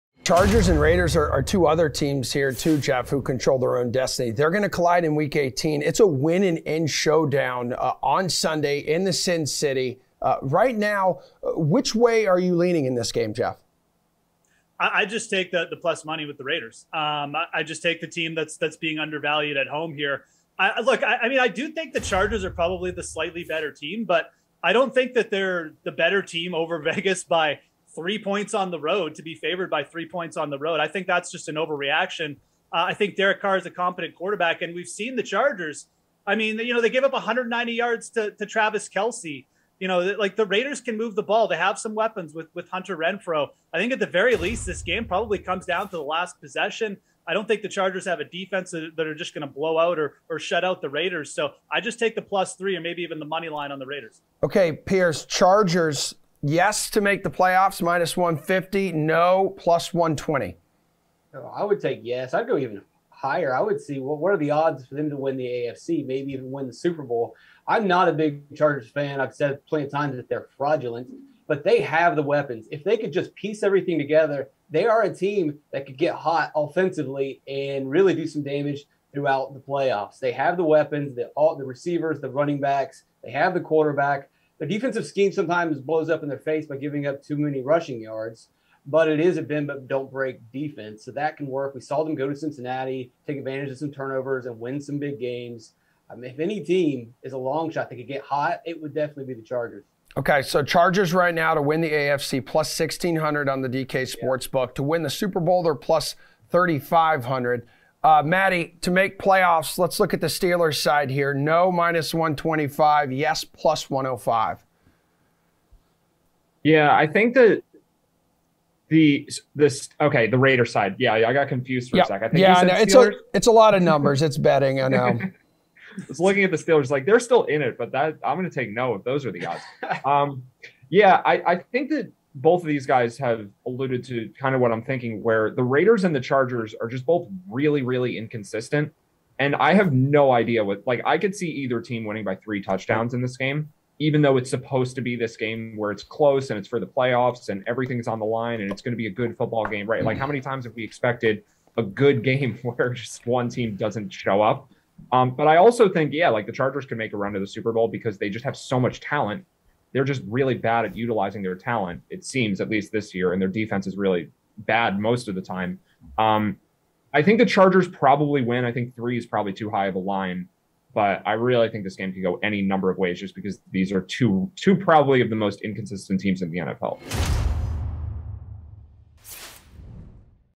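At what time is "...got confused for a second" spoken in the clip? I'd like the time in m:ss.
2:01.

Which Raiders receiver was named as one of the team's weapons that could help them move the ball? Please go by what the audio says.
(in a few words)
Hunter Renfrow.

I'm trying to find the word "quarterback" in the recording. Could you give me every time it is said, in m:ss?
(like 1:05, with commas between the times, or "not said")
0:34, 1:23.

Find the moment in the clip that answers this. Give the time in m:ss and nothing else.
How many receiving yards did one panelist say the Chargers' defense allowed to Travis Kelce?
0:37.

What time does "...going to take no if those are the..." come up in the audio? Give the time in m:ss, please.
2:08.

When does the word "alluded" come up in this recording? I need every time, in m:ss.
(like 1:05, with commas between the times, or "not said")
2:13.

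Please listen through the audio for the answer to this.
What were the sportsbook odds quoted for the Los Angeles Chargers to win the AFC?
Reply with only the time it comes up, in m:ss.
1:42.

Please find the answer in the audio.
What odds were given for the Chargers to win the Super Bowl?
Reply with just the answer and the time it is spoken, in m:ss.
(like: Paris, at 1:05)
+3500, at 1:45.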